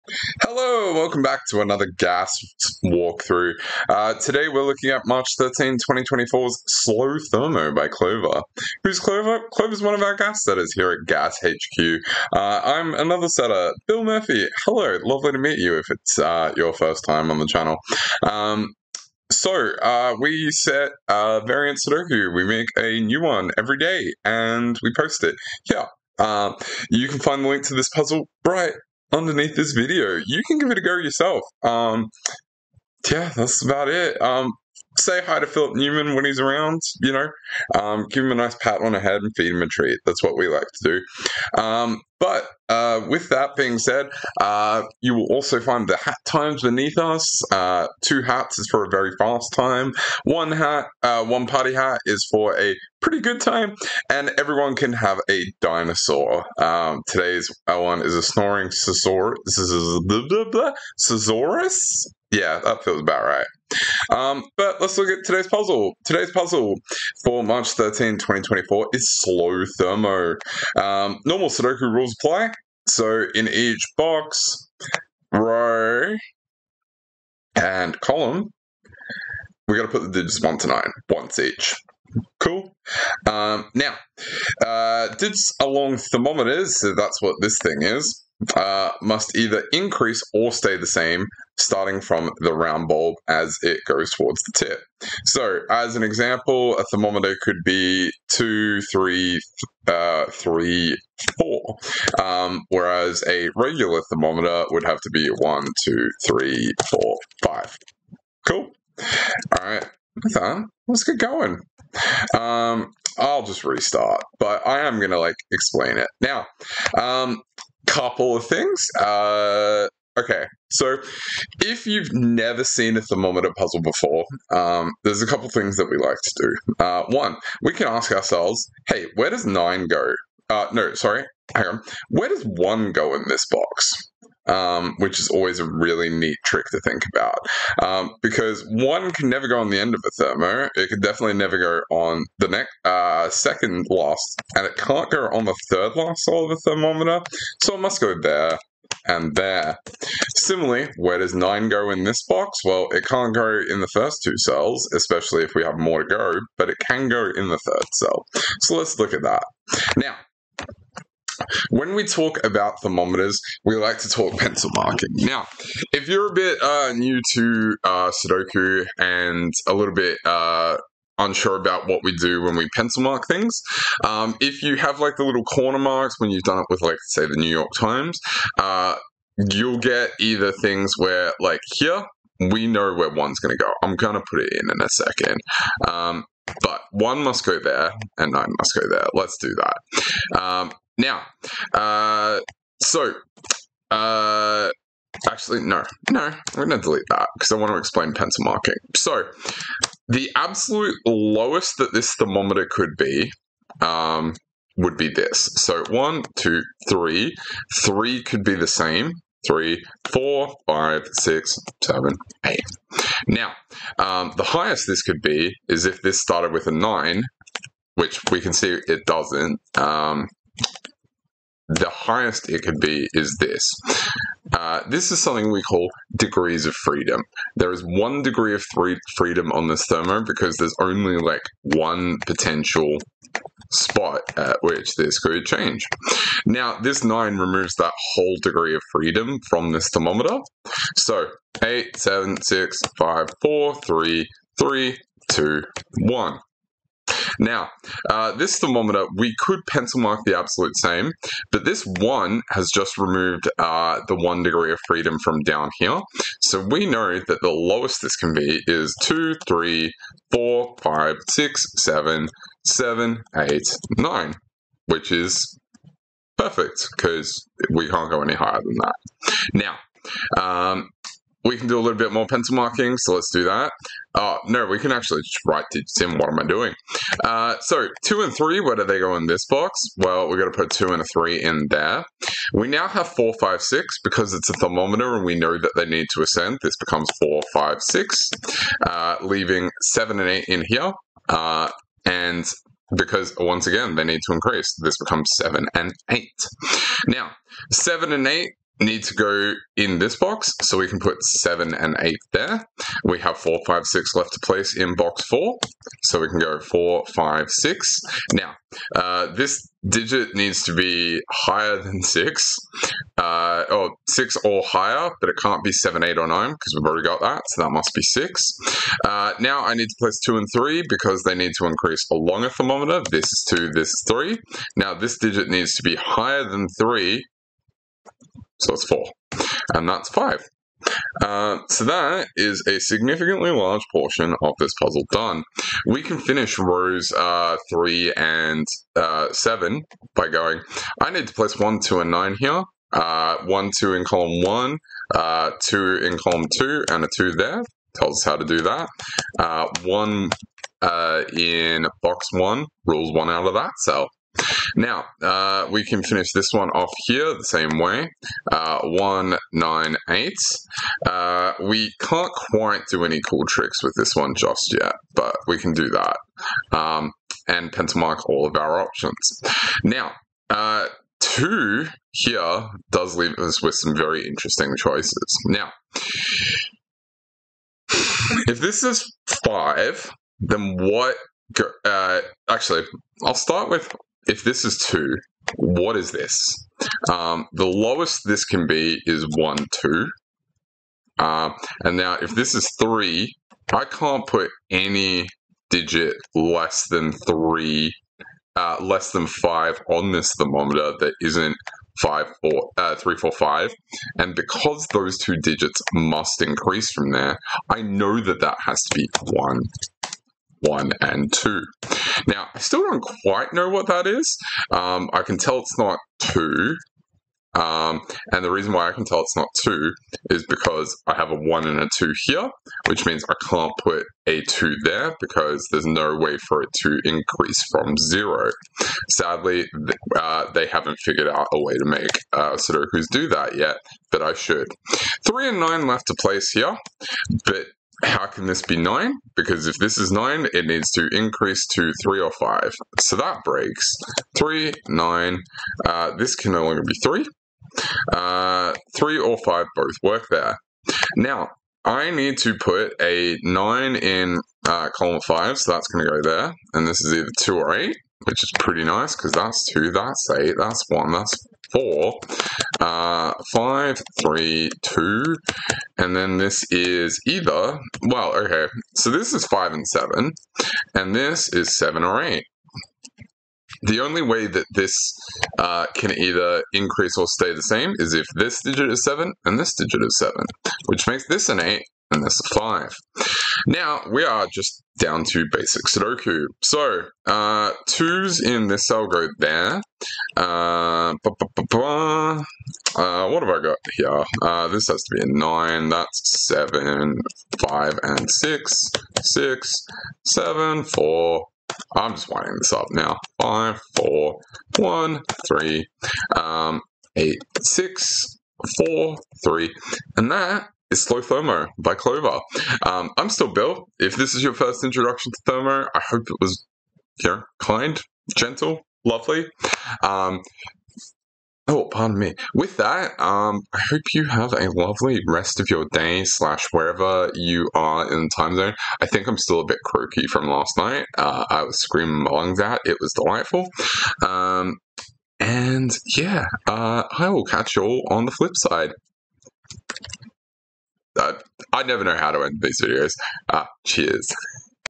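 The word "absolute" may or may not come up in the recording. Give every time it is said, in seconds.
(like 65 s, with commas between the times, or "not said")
200 s, 250 s.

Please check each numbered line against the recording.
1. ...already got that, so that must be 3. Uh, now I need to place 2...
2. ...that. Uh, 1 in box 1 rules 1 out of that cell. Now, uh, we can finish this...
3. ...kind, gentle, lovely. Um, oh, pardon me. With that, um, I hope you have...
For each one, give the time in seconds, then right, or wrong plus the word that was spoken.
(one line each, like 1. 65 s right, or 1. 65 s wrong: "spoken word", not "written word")
1. 316 s wrong: "6", not "3"
2. 348 s right
3. 517 s right.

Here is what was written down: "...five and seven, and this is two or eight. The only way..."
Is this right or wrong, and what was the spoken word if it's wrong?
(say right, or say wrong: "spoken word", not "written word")
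wrong: "seven", not "two".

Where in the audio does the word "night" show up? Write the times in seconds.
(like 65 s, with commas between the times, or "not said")
530 s.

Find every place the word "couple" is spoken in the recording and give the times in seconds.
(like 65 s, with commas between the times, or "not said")
117 s, 125 s.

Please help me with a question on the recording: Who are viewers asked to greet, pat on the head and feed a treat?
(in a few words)
Philip Newman.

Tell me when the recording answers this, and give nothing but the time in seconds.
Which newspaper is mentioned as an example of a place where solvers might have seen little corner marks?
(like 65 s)
177 s.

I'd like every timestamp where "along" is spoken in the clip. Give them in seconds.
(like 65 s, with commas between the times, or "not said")
85 s, 322 s.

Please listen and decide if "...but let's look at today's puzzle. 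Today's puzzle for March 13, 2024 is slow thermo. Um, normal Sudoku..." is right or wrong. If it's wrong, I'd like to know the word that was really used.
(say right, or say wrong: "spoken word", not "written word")
right.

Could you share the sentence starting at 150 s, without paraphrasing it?
Similarly, where does 9 go in this box?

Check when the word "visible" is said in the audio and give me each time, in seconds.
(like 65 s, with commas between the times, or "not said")
not said.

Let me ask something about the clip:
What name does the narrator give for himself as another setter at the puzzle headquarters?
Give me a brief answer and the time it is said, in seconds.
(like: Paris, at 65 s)
Bill Murphy, at 13 s.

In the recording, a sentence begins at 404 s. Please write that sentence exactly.
And because those two digits must increase from there, I know that that has to be one, one, and two.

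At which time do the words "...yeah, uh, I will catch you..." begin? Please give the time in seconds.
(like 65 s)
536 s.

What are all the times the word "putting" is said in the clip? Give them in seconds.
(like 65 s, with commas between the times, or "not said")
not said.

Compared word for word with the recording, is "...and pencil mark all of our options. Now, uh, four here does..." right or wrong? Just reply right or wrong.
wrong.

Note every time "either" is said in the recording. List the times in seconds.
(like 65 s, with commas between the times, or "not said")
89 s, 180 s, 457 s, 467 s, 476 s.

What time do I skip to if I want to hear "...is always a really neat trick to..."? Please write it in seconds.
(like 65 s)
135 s.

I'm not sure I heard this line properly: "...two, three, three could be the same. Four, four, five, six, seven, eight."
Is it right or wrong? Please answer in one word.
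wrong.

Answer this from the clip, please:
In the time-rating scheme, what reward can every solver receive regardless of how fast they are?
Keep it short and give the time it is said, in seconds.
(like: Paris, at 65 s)
a dinosaur, at 55 s.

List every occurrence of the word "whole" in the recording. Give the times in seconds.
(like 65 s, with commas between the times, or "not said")
238 s.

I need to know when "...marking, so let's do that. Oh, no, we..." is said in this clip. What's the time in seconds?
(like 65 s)
272 s.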